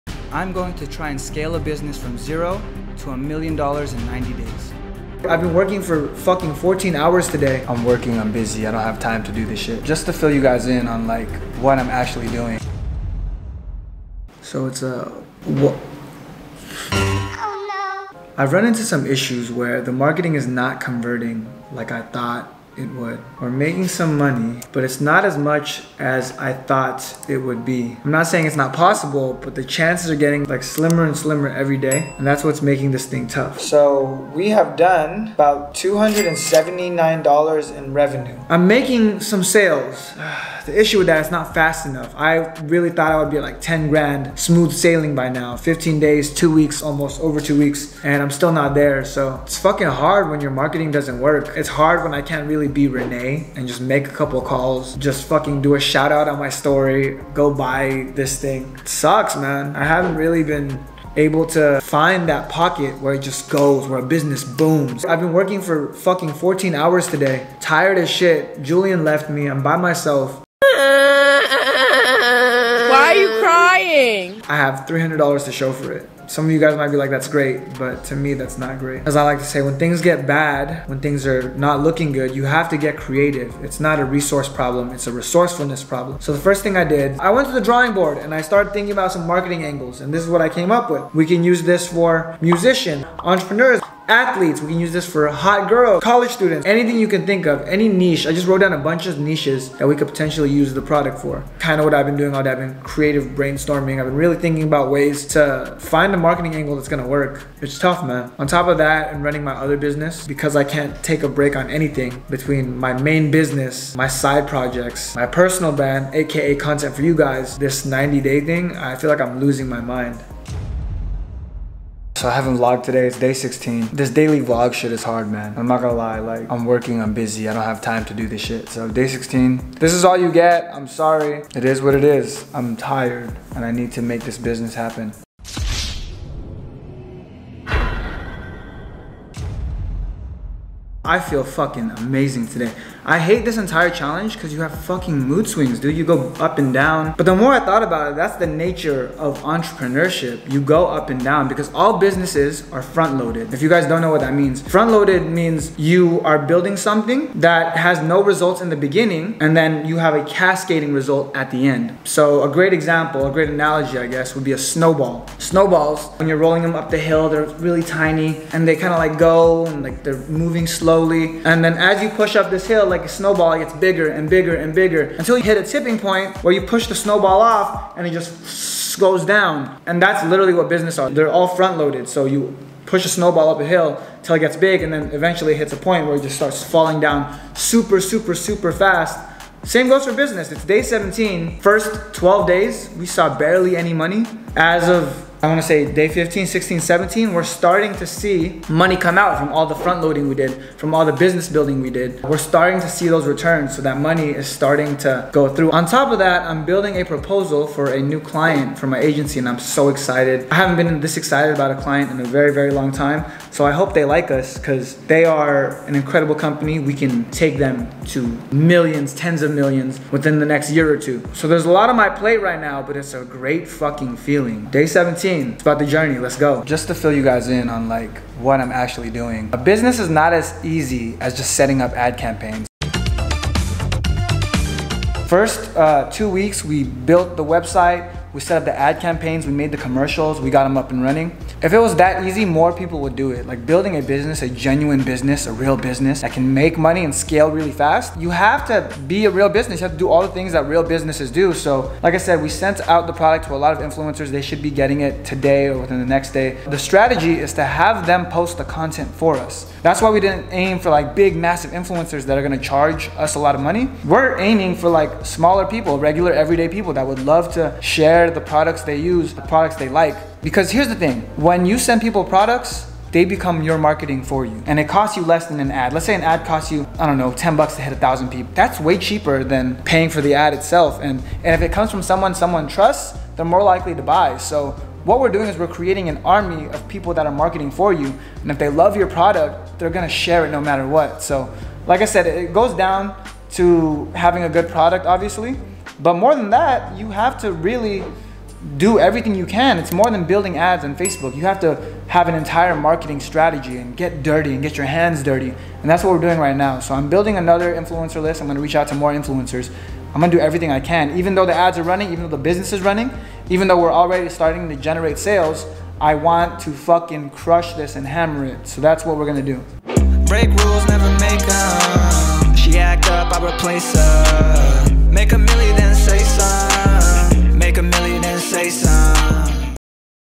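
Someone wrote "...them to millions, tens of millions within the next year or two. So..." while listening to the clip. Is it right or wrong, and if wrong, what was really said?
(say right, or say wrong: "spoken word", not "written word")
right.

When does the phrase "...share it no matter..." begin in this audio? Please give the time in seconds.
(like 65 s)
290 s.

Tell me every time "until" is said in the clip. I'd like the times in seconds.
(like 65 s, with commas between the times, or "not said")
175 s, 184 s.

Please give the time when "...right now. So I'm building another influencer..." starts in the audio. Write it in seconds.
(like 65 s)
306 s.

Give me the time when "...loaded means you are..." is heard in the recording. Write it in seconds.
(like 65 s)
154 s.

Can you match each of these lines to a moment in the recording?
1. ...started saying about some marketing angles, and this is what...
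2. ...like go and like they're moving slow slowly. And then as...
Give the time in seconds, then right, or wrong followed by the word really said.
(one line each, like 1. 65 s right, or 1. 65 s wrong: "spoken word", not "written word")
1. 88 s wrong: "thinking", not "saying"
2. 168 s right.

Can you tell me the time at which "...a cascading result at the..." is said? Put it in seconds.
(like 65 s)
160 s.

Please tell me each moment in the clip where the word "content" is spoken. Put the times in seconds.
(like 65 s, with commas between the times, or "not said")
116 s, 258 s.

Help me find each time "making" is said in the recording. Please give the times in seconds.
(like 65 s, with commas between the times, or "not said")
23 s, 32 s, 38 s.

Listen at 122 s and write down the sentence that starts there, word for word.
So I haven't vlogged today, it's day 16.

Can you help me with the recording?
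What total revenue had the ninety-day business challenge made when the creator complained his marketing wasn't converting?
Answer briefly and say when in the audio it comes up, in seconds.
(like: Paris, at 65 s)
$279, at 35 s.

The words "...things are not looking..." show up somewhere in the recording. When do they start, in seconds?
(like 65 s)
81 s.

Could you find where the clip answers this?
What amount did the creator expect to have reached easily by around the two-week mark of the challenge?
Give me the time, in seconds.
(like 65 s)
43 s.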